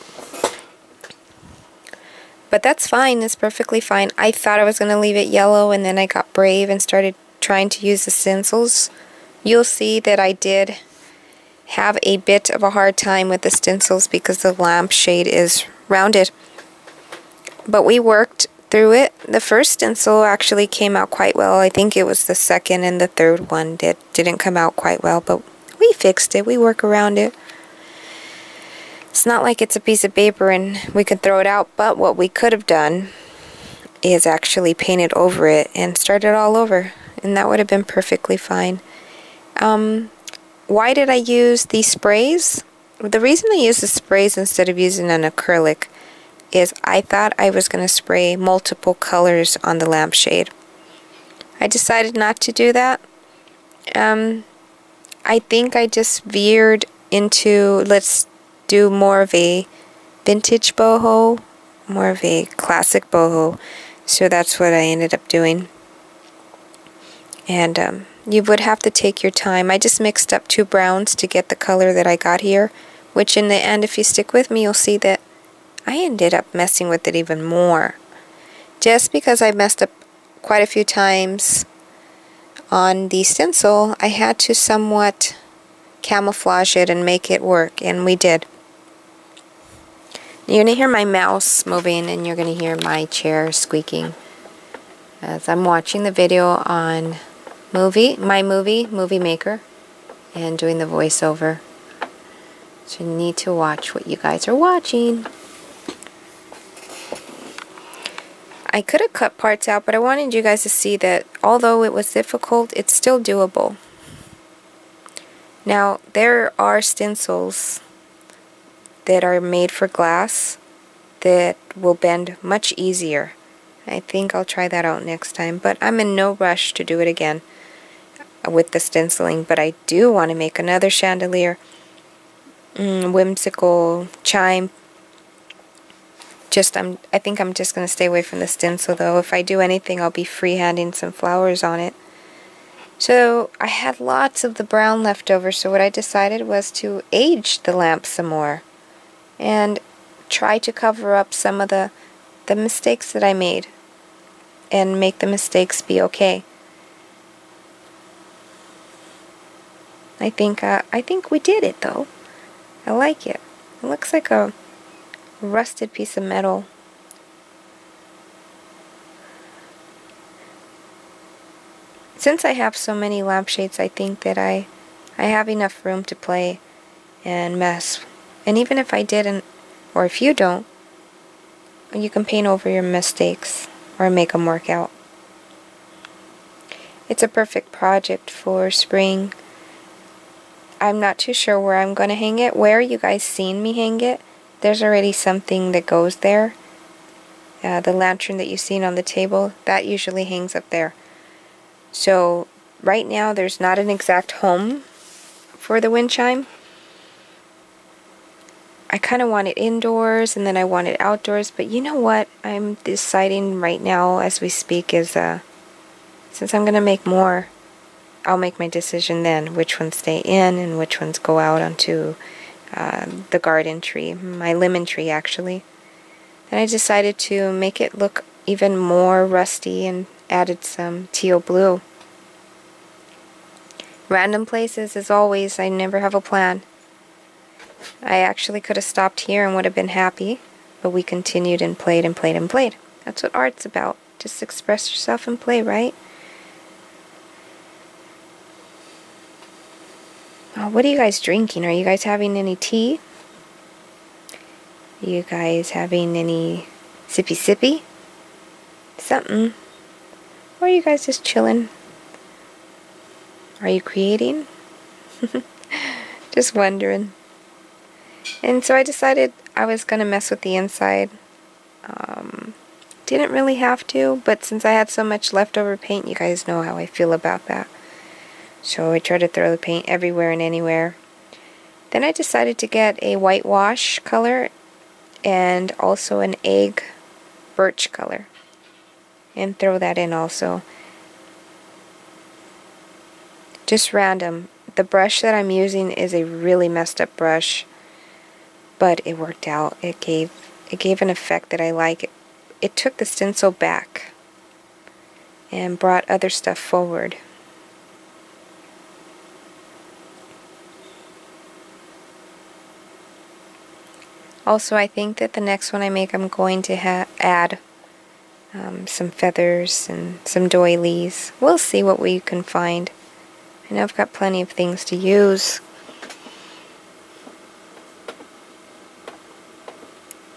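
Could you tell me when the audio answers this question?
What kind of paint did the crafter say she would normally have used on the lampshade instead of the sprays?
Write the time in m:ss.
0:45.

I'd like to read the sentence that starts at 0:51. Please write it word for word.
I decided not to do that.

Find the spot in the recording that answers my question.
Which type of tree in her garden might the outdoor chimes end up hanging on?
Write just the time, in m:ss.
3:44.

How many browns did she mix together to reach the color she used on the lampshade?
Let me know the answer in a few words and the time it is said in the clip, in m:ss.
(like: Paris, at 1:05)
2, at 1:10.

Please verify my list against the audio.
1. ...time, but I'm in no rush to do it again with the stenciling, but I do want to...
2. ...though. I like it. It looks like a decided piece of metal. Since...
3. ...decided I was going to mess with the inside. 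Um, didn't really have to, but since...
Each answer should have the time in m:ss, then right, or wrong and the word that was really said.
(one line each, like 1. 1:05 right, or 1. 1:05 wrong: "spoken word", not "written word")
1. 2:05 right
2. 2:41 wrong: "rusted", not "decided"
3. 4:28 right.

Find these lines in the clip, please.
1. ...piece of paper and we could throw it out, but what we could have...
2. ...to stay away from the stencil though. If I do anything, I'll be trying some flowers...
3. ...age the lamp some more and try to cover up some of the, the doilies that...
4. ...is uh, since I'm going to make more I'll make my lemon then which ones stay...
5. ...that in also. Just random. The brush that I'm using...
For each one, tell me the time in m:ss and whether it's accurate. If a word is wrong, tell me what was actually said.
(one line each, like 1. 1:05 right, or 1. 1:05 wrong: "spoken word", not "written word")
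1. 0:29 right
2. 2:17 wrong: "freehanding", not "trying"
3. 2:27 wrong: "mistakes", not "doilies"
4. 3:34 wrong: "decision", not "lemon"
5. 4:49 right.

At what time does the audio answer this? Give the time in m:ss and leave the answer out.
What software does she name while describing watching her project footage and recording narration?
1:38.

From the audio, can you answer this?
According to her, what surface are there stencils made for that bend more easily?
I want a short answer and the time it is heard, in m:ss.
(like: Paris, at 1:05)
Glass, at 1:59.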